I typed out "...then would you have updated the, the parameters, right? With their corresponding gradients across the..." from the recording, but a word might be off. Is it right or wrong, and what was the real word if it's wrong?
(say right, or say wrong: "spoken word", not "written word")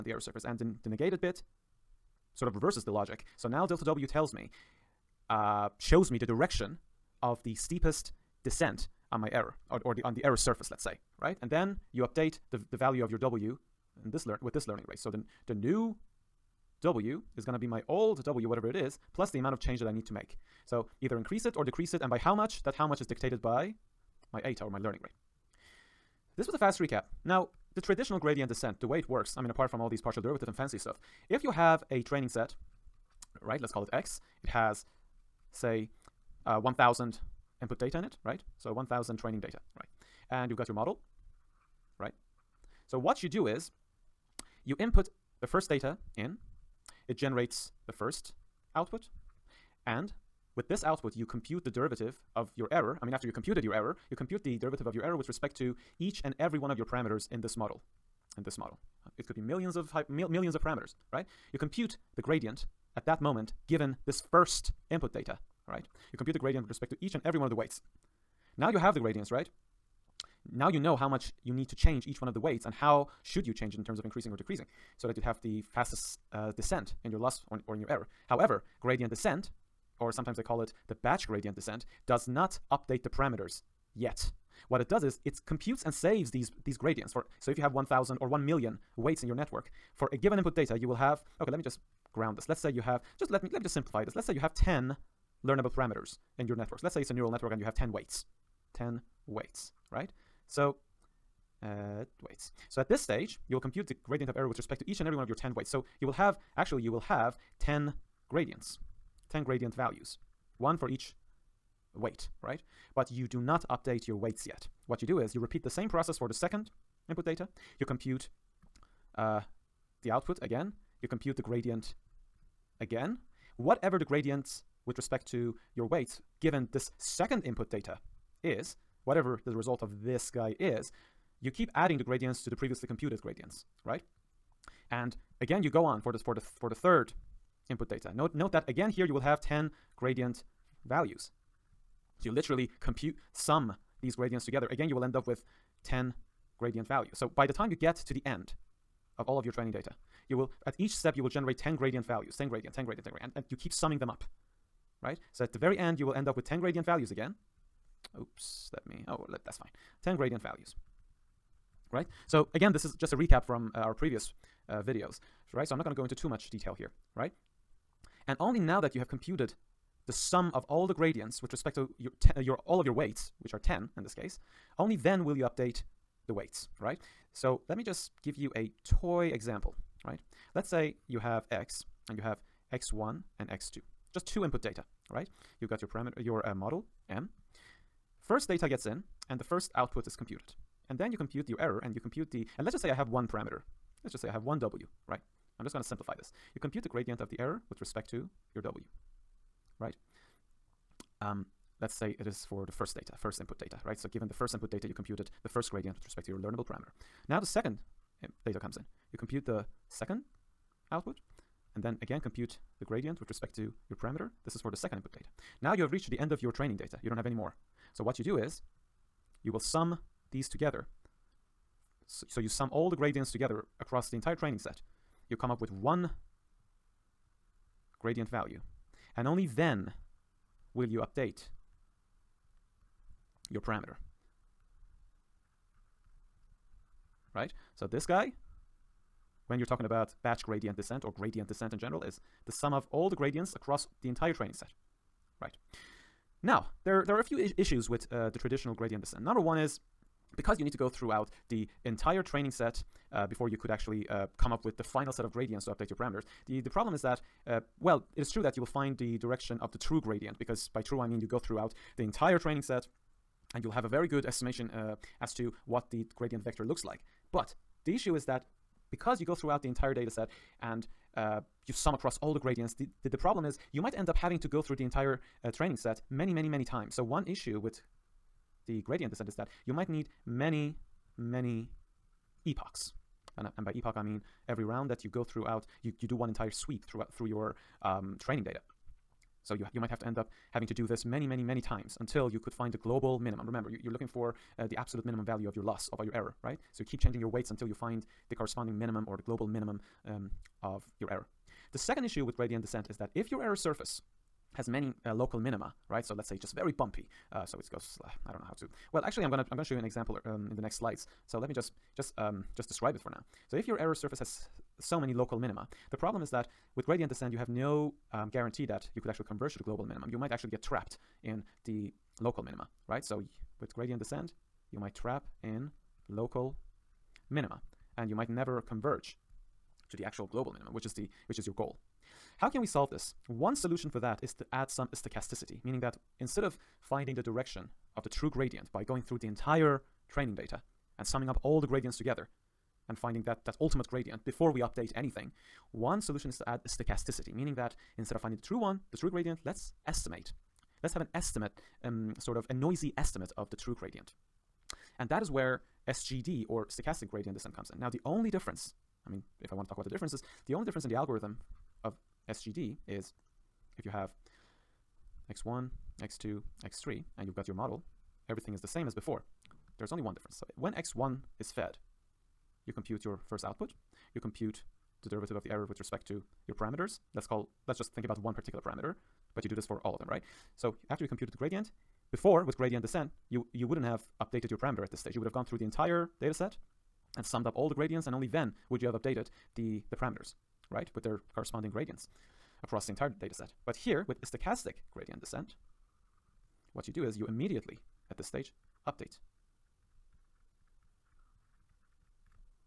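right.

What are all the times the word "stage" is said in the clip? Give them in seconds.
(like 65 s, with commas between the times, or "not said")
102 s, 384 s, 398 s.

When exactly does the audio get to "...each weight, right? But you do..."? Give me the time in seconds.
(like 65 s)
110 s.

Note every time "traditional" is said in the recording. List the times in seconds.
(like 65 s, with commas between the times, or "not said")
27 s, 248 s.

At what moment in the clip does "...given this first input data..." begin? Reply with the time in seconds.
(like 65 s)
63 s.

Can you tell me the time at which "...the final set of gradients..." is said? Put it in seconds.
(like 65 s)
254 s.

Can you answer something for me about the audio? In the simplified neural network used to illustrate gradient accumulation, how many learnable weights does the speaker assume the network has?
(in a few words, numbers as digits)
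10.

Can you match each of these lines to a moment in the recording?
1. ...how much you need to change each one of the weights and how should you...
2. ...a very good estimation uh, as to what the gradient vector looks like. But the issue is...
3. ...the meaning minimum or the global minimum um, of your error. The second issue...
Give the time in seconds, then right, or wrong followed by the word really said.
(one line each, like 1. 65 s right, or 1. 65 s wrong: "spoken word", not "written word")
1. 70 s right
2. 263 s right
3. 298 s wrong: "corresponding", not "meaning".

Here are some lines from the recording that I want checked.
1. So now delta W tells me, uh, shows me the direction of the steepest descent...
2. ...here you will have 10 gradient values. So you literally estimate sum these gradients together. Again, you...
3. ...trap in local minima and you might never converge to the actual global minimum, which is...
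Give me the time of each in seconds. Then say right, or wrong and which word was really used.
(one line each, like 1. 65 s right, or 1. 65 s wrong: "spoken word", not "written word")
1. 3 s right
2. 138 s wrong: "compute", not "estimate"
3. 324 s right.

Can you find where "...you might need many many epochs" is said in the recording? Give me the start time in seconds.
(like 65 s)
279 s.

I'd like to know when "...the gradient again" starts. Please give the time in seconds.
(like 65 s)
121 s.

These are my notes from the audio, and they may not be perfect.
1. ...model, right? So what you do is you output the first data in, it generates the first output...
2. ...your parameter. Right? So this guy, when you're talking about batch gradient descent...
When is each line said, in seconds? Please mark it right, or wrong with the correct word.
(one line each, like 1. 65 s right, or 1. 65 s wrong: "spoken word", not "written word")
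1. 40 s wrong: "input", not "output"
2. 233 s right.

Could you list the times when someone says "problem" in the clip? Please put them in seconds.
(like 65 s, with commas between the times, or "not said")
256 s, 273 s, 315 s.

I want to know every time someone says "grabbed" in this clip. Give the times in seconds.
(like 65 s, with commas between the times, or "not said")
not said.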